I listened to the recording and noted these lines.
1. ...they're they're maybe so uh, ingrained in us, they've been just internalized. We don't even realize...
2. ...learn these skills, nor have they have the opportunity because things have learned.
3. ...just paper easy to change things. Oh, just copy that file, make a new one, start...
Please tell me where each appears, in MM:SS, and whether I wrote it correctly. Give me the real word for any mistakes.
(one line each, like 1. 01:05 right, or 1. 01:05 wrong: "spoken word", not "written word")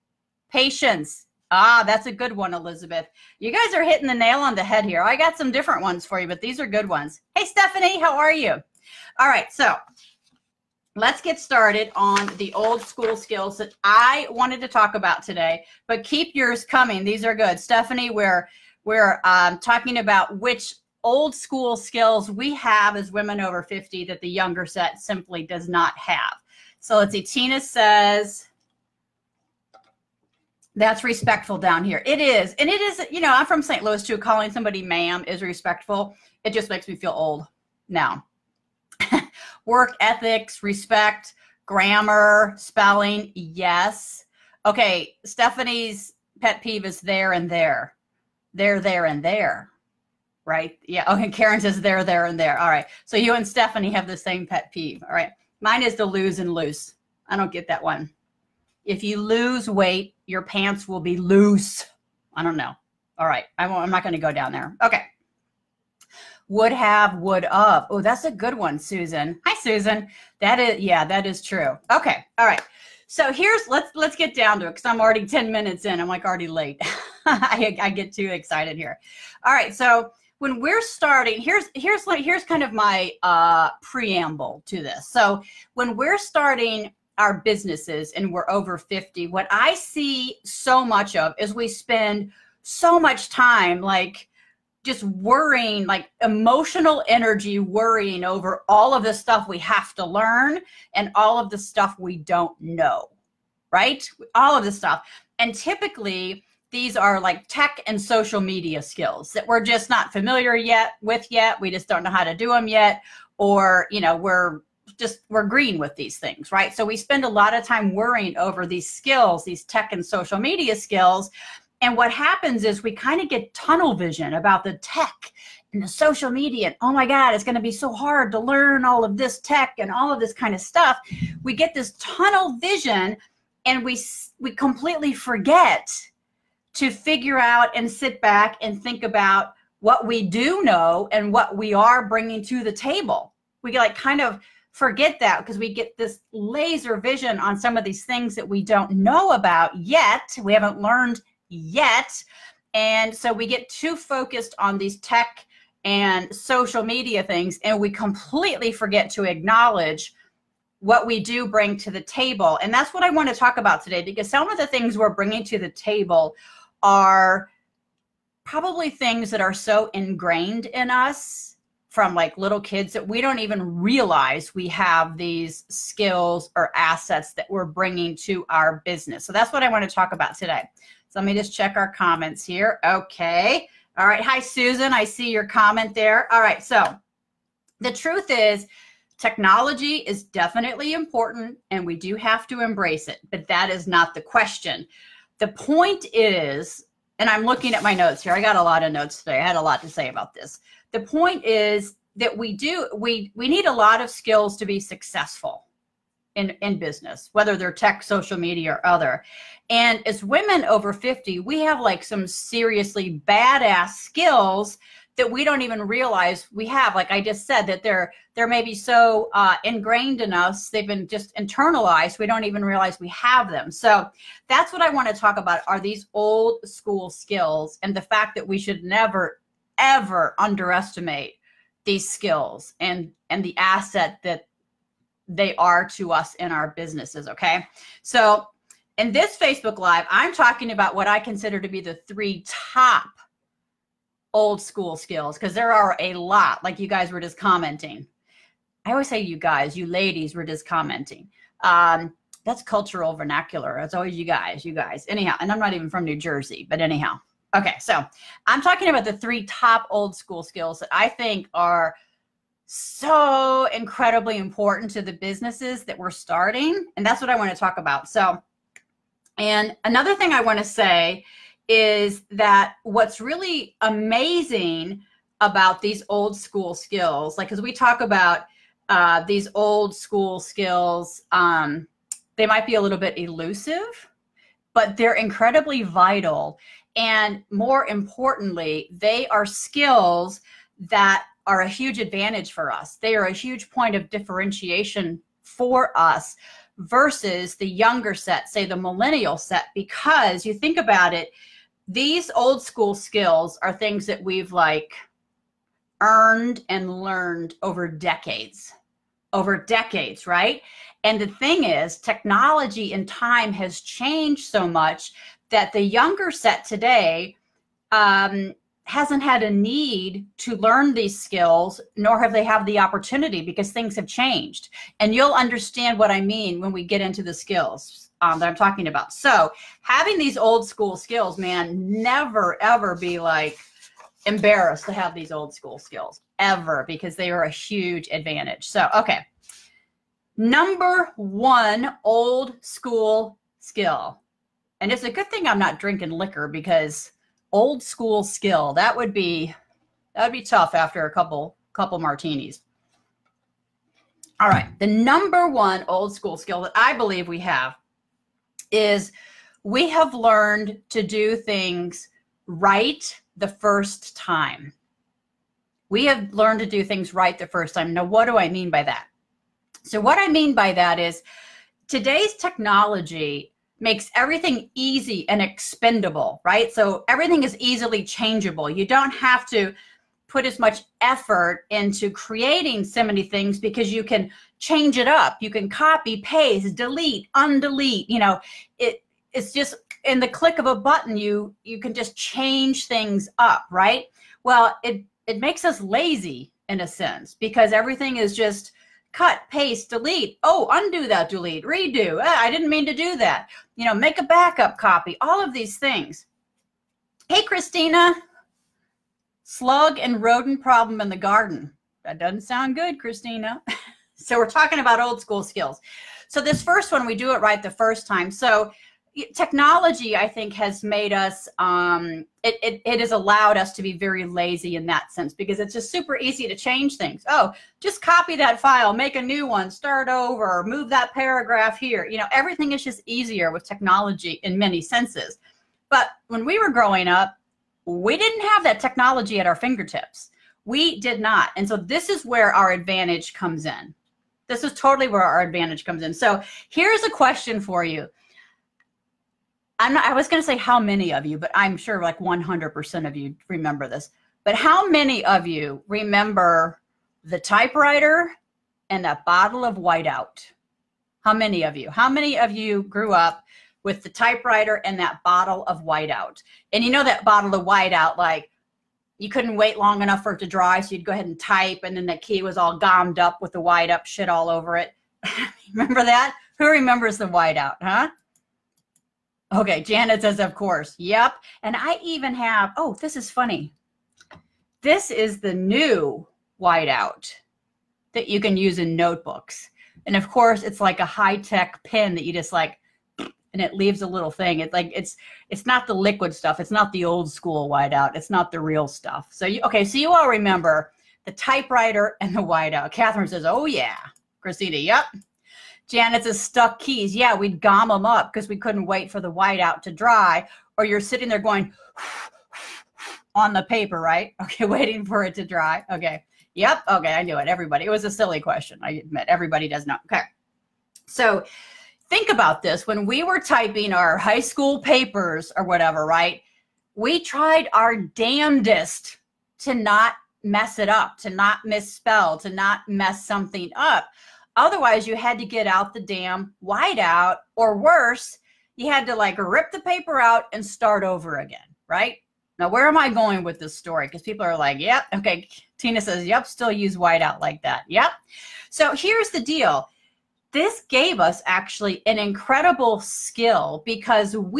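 1. 03:37 right
2. 05:20 wrong: "changed", not "learned"
3. 07:05 wrong: "super", not "paper".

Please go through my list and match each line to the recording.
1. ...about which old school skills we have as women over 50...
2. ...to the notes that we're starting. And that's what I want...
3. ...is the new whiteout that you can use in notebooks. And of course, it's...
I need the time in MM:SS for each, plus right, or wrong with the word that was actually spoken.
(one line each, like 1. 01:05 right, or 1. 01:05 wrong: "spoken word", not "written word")
1. 00:19 right
2. 04:24 wrong: "businesses", not "notes"
3. 08:05 right.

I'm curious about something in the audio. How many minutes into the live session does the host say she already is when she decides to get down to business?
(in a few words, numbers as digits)
10.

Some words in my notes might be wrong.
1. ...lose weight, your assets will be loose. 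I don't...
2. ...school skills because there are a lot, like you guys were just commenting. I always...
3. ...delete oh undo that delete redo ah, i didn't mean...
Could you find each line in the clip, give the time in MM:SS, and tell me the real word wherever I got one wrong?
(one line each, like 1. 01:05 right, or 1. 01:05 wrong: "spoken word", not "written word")
1. 00:59 wrong: "pants", not "assets"
2. 04:04 right
3. 06:39 right.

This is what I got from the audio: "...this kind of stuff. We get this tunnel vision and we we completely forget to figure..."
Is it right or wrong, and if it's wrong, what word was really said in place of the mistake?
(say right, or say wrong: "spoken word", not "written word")
right.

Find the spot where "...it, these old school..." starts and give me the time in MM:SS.
05:01.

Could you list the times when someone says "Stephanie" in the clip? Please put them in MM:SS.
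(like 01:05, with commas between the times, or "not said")
00:07, 00:17, 00:45, 00:53.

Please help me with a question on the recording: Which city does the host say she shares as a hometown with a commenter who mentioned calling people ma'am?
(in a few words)
St. Louis.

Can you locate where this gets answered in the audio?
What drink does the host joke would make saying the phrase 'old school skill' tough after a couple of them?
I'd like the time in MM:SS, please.
05:51.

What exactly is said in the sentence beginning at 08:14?
It's like it's it's not the liquid stuff.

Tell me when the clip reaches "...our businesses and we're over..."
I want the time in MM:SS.
01:27.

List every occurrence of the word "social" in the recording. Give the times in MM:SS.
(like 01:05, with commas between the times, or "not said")
01:48, 02:00, 02:05, 02:36, 03:28.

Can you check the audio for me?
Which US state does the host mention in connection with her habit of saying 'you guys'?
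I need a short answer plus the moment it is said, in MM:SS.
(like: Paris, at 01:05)
New Jersey, at 04:16.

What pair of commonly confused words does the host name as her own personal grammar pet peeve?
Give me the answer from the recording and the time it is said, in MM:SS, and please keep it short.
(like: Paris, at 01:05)
lose and loose, at 00:56.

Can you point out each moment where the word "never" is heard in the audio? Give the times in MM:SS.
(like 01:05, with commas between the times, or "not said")
03:48, 05:32.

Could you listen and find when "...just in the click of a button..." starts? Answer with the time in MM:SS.
06:29.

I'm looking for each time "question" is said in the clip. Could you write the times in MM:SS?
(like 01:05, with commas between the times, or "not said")
03:14, 07:27, 08:38.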